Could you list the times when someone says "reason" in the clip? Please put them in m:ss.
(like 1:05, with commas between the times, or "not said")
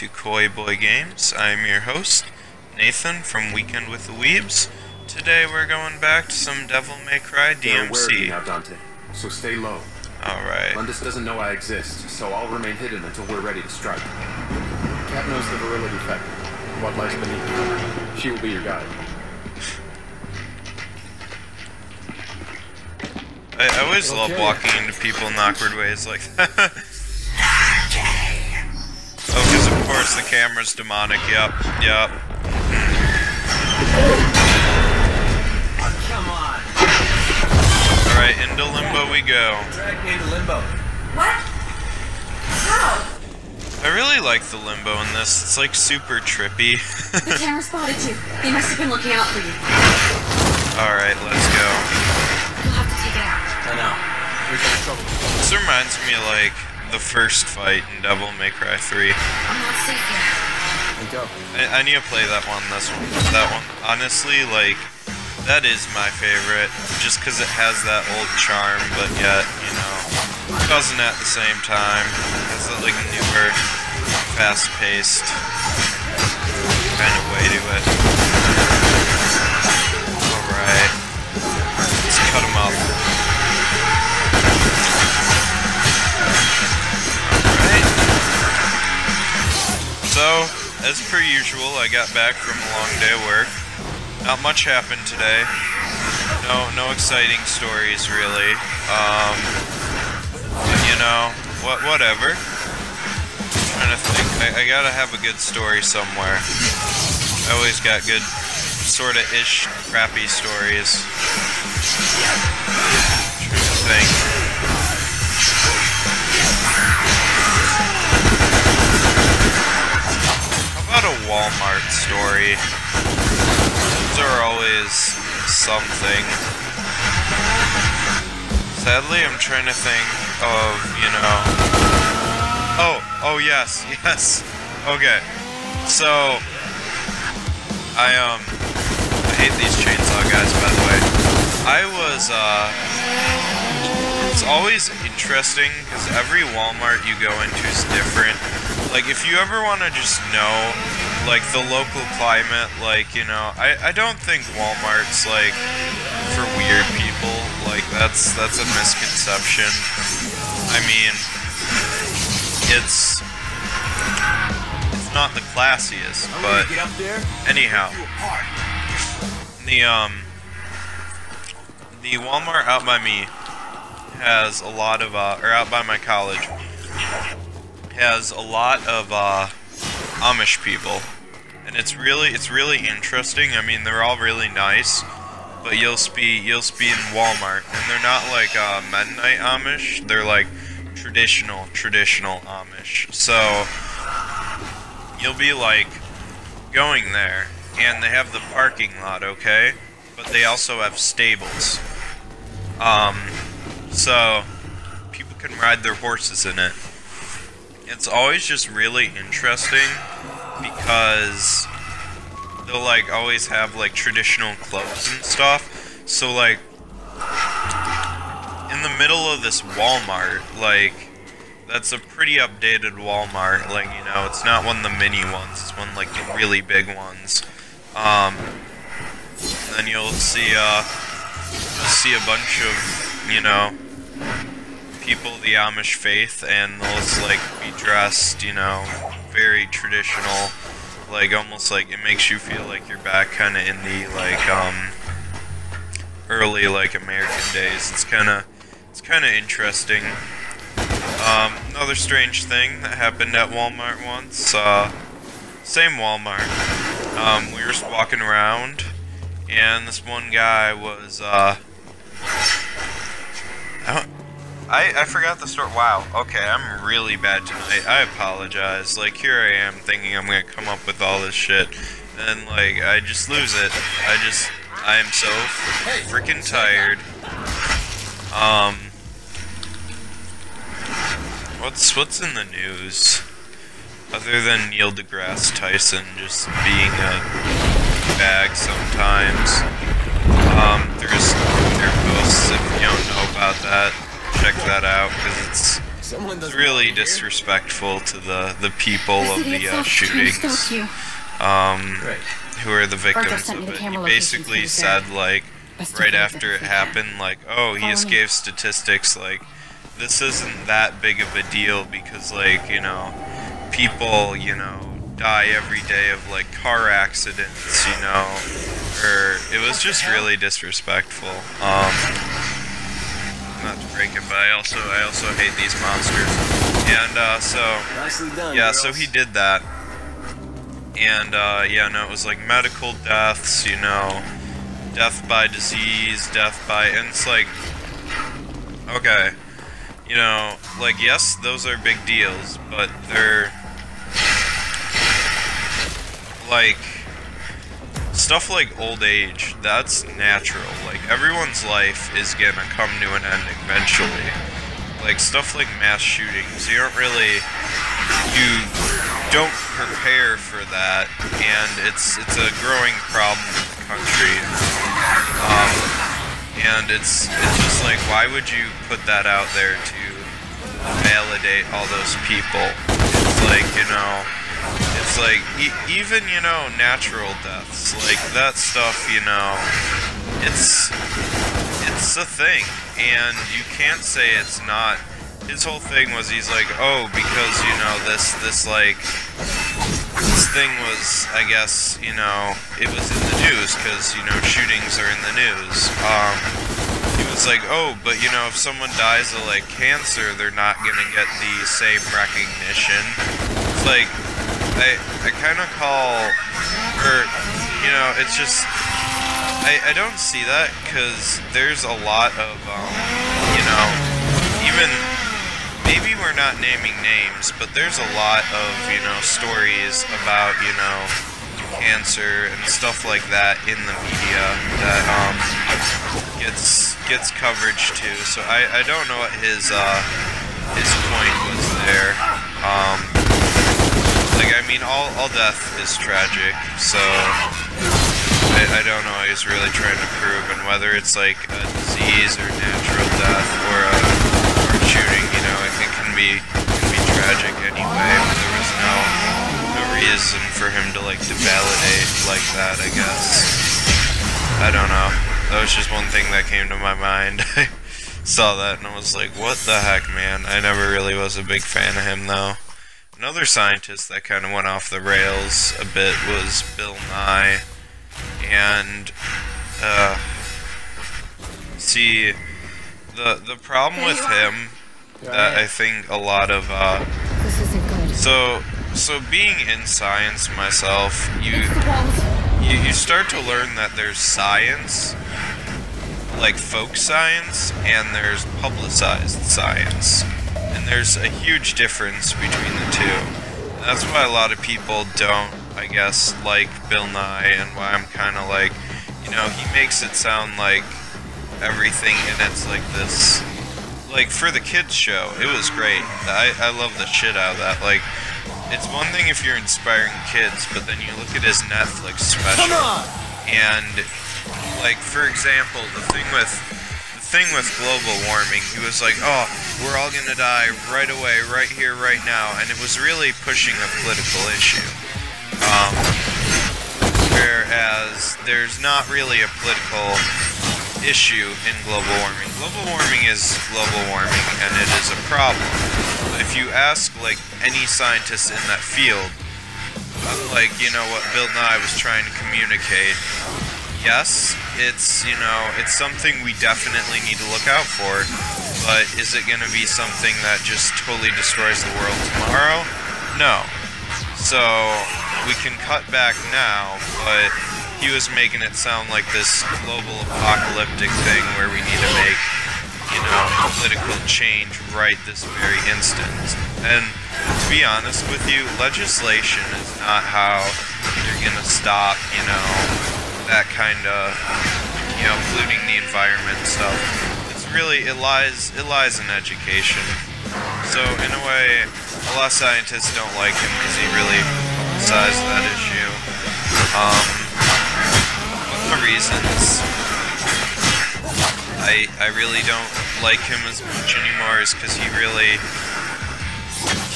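7:29, 9:49.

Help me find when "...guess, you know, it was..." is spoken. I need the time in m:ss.
6:31.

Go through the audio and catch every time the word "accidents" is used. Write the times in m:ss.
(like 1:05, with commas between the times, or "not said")
5:16.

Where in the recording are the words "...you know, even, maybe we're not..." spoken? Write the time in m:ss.
6:53.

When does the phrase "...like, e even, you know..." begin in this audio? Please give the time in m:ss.
6:15.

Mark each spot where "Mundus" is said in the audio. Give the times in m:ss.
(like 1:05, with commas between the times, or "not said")
0:10.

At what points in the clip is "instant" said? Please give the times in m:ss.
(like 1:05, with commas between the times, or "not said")
9:25.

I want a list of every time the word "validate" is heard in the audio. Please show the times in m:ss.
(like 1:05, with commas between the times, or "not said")
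6:11, 7:31.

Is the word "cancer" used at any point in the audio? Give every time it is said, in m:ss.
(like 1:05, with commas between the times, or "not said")
6:39, 7:01.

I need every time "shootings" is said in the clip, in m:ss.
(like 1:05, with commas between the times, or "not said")
4:59, 5:55, 6:34, 7:24.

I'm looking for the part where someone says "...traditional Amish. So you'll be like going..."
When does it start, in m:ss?
3:11.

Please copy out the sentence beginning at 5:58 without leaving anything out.
You don't prepare for that, and it's it's a growing problem in the country.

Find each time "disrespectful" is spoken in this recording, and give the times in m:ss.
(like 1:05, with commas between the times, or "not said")
4:56, 5:20.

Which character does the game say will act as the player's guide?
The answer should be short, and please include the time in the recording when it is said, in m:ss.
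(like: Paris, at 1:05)
Kat, at 0:13.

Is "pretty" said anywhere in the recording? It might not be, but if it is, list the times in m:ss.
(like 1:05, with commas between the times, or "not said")
3:41.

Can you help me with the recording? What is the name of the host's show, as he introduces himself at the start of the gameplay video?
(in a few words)
Weekend with the Weebs.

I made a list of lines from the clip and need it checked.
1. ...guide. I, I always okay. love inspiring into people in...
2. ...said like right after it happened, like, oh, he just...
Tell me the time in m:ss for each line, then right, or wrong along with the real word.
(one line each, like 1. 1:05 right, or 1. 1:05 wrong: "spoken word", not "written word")
1. 0:18 wrong: "walking", not "inspiring"
2. 5:04 right.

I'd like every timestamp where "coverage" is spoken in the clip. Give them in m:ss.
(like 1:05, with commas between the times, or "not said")
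7:07.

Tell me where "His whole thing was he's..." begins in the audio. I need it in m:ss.
6:25.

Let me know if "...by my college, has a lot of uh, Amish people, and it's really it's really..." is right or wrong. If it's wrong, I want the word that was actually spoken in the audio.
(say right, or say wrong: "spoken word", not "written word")
right.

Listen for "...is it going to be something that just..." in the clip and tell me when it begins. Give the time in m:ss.
9:09.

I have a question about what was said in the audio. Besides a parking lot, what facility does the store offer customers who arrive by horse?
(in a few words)
Stables.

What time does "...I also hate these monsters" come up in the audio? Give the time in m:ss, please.
5:24.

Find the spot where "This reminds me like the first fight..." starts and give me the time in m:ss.
0:55.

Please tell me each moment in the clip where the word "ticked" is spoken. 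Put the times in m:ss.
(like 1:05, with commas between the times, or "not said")
not said.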